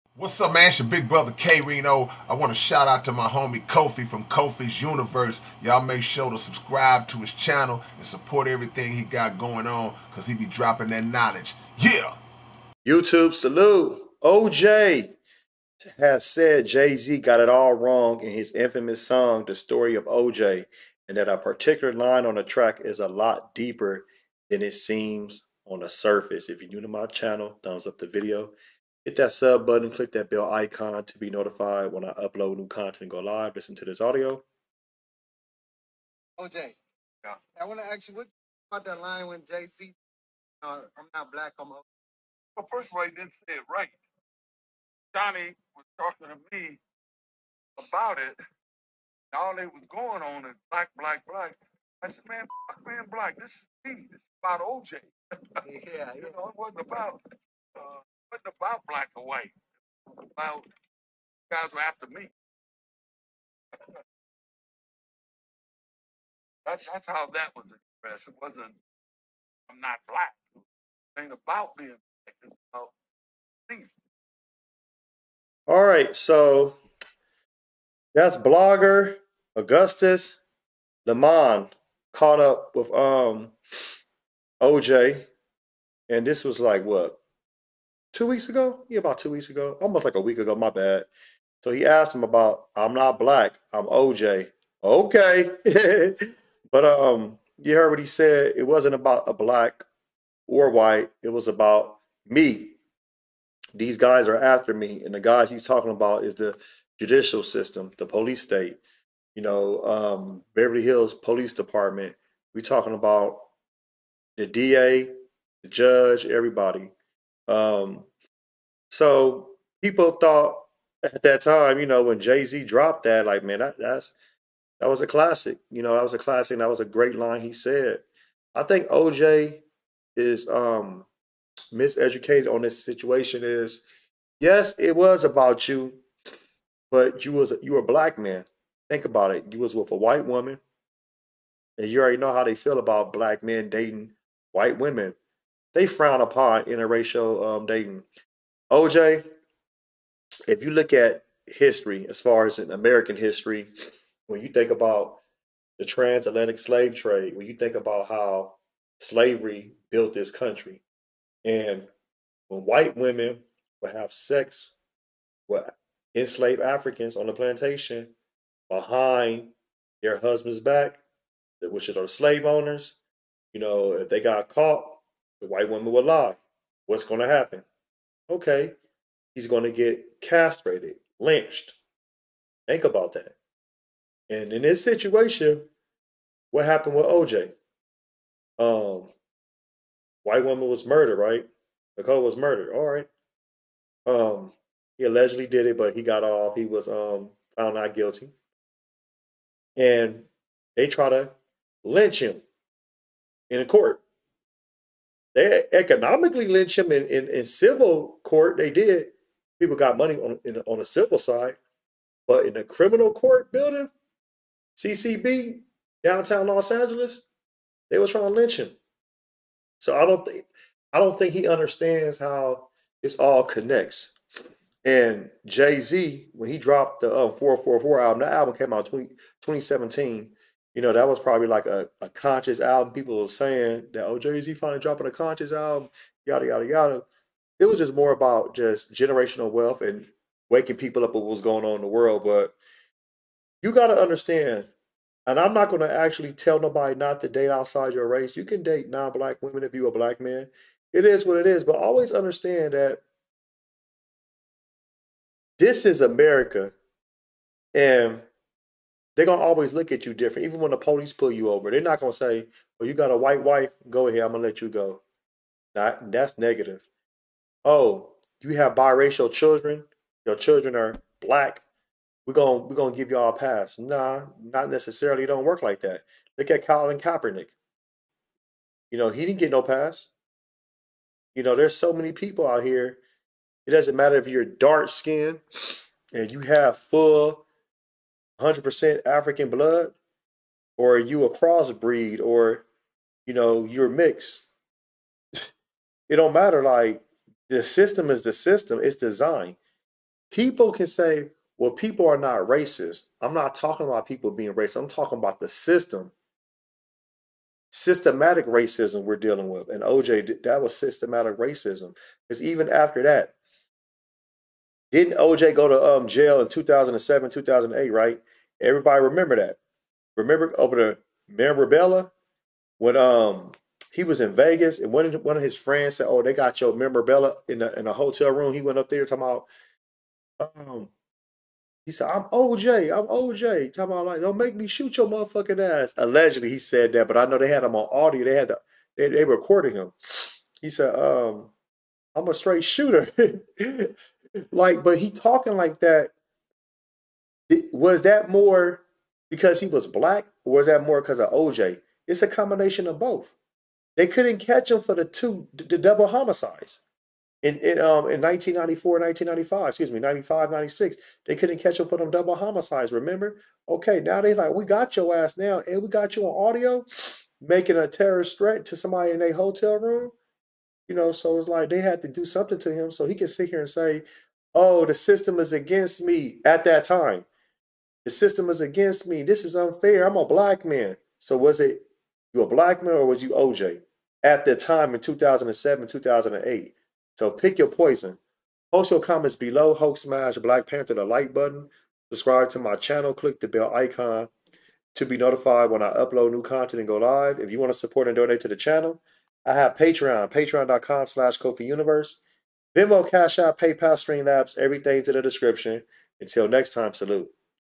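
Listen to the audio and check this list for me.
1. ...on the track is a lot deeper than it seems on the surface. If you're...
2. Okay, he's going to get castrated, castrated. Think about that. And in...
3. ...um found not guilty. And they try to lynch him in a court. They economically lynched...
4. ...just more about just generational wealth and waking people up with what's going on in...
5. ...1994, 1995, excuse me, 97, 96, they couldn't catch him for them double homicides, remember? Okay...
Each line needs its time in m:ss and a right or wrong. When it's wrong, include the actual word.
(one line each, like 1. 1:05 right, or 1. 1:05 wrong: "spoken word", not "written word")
1. 0:22 right
2. 2:58 wrong: "lynched", not "castrated"
3. 3:16 right
4. 3:57 right
5. 5:58 wrong: "95", not "97".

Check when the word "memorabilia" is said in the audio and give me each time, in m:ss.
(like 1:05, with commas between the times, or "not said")
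5:21, 5:26.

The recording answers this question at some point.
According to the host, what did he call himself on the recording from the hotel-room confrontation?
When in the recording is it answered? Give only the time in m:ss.
5:42.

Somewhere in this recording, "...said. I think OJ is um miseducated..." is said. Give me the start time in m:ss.
2:07.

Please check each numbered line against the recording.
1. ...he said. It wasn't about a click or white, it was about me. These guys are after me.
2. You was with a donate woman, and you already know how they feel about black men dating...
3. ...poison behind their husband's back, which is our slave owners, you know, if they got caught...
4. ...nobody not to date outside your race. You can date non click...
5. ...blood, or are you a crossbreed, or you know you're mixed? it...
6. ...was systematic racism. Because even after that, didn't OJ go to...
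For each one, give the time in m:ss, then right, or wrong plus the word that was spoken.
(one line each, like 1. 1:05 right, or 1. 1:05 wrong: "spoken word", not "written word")
1. 1:37 wrong: "black", not "click"
2. 2:19 wrong: "white", not "donate"
3. 2:47 wrong: "plantation", not "poison"
4. 4:06 wrong: "black", not "click"
5. 4:49 right
6. 5:10 right.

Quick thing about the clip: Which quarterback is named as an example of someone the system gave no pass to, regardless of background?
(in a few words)
Colin Kaepernick.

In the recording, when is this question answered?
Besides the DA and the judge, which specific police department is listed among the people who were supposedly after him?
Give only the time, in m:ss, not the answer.
1:50.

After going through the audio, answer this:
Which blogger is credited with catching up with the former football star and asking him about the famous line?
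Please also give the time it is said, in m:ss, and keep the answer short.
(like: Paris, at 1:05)
Augustus Lemon, at 1:19.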